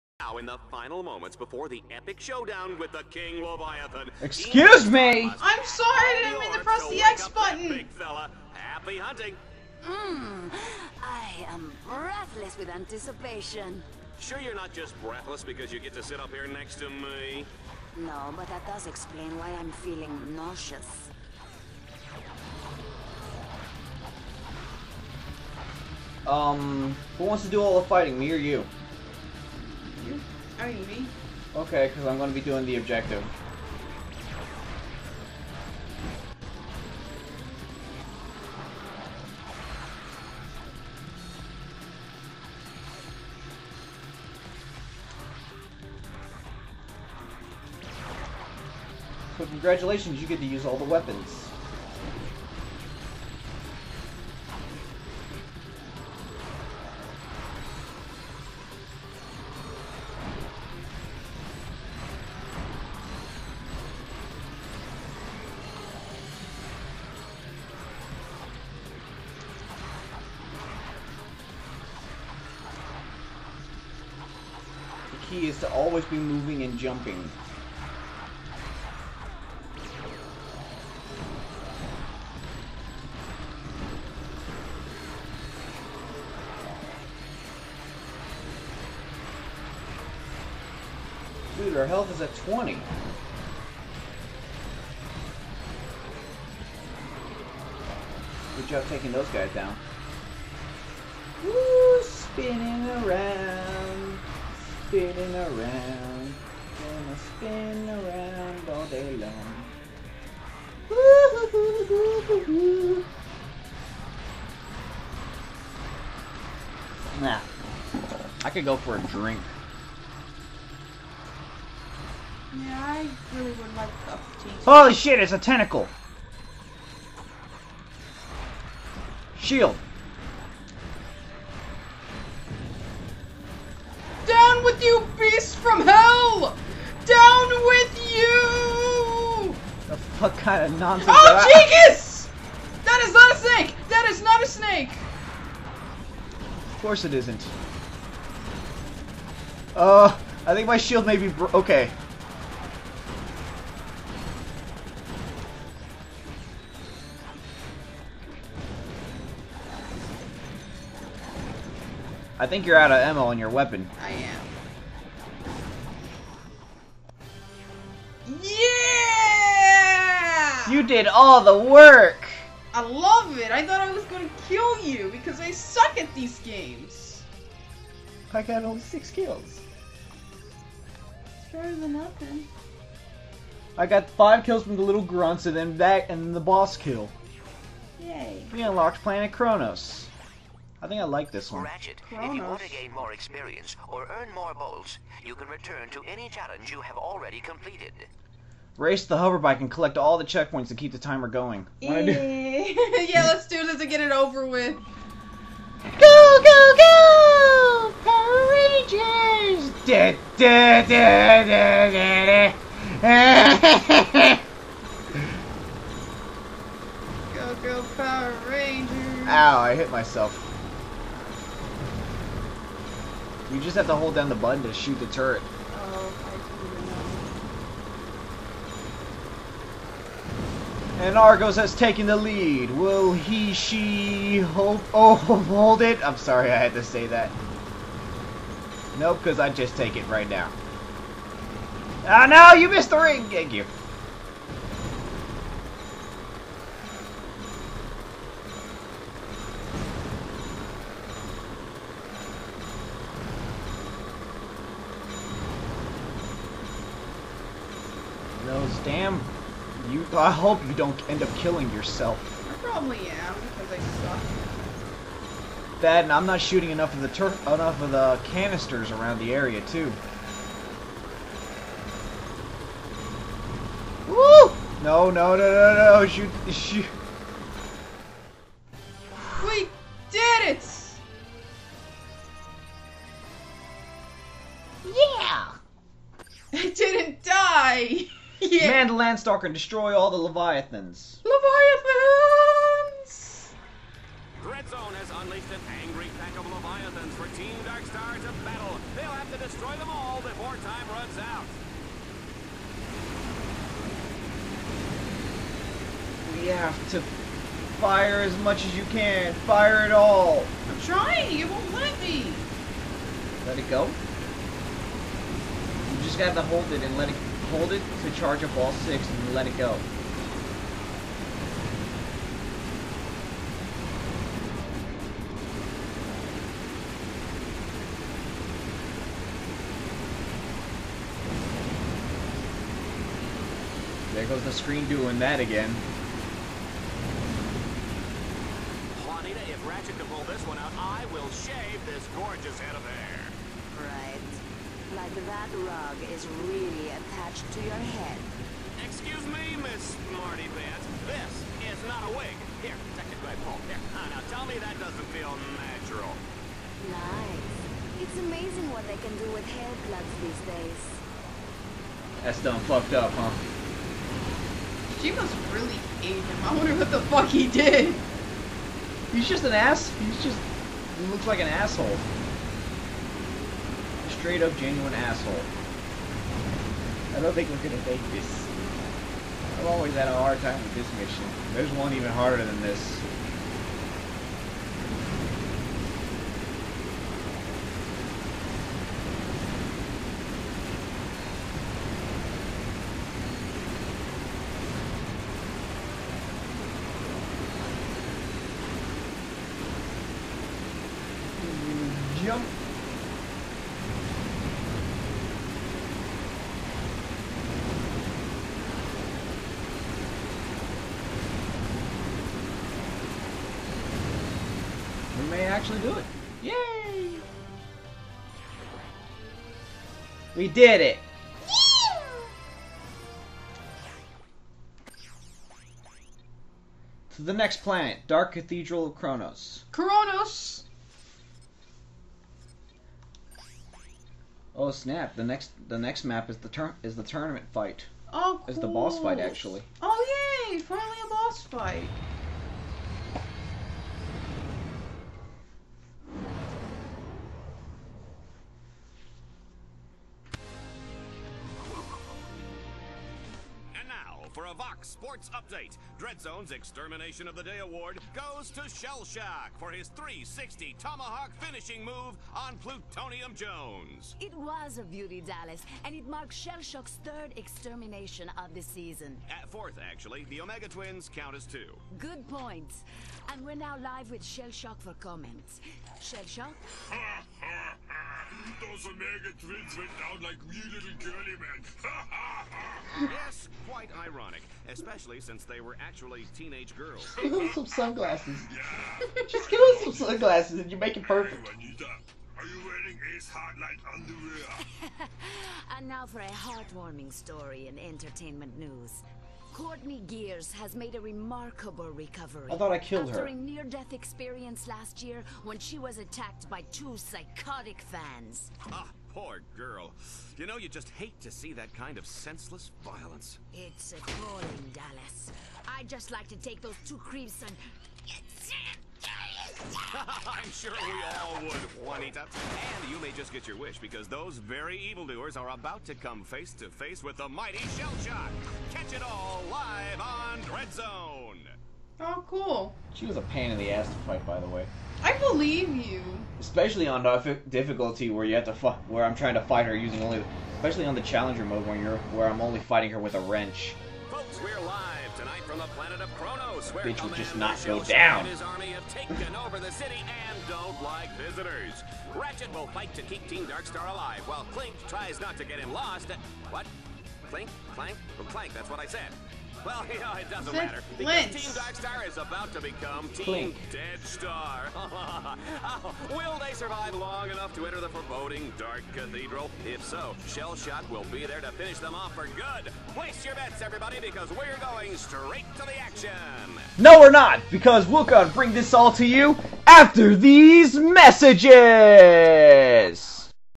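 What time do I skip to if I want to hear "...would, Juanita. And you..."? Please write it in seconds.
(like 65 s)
521 s.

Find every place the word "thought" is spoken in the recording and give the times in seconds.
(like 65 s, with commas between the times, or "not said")
173 s, 502 s.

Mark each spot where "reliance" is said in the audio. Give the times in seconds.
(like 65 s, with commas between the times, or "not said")
not said.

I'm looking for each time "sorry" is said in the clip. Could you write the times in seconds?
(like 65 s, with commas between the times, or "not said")
5 s, 236 s.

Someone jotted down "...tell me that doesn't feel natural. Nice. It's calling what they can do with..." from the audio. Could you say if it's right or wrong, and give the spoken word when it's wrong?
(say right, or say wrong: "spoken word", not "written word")
wrong: "amazing", not "calling".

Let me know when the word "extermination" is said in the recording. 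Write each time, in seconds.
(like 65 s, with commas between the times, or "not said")
456 s, 467 s.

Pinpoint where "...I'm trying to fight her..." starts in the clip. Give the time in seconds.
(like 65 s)
539 s.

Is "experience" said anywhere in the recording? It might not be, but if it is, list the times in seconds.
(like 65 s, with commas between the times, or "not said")
193 s, 503 s.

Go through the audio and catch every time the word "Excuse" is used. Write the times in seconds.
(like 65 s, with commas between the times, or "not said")
4 s, 348 s.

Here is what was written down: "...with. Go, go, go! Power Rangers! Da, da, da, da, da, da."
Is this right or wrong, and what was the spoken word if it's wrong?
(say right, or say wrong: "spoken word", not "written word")
right.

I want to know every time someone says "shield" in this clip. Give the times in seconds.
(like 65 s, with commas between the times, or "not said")
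129 s, 150 s.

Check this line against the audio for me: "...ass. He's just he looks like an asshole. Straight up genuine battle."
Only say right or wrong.
wrong.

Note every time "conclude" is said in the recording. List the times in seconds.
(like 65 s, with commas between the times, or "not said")
not said.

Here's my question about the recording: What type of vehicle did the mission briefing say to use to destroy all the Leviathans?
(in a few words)
Landstalker.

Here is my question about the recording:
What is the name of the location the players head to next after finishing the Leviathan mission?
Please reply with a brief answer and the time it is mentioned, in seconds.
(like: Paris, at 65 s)
Dark Cathedral of Kronos, at 428 s.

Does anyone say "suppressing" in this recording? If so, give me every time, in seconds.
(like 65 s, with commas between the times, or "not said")
not said.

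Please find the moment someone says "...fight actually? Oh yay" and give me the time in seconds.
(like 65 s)
438 s.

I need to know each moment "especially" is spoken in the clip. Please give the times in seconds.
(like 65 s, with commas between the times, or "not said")
484 s, 536 s, 540 s.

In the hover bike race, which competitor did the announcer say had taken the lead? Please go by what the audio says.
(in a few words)
Argos.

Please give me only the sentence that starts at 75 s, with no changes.
key is to always be moving and jumping.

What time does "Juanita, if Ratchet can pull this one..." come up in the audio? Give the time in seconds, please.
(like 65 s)
339 s.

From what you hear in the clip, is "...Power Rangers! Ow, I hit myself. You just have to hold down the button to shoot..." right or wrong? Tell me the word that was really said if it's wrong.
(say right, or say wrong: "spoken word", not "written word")
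right.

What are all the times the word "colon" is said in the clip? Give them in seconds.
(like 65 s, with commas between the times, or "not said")
not said.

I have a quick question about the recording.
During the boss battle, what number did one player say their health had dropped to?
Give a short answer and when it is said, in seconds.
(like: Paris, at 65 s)
20, at 92 s.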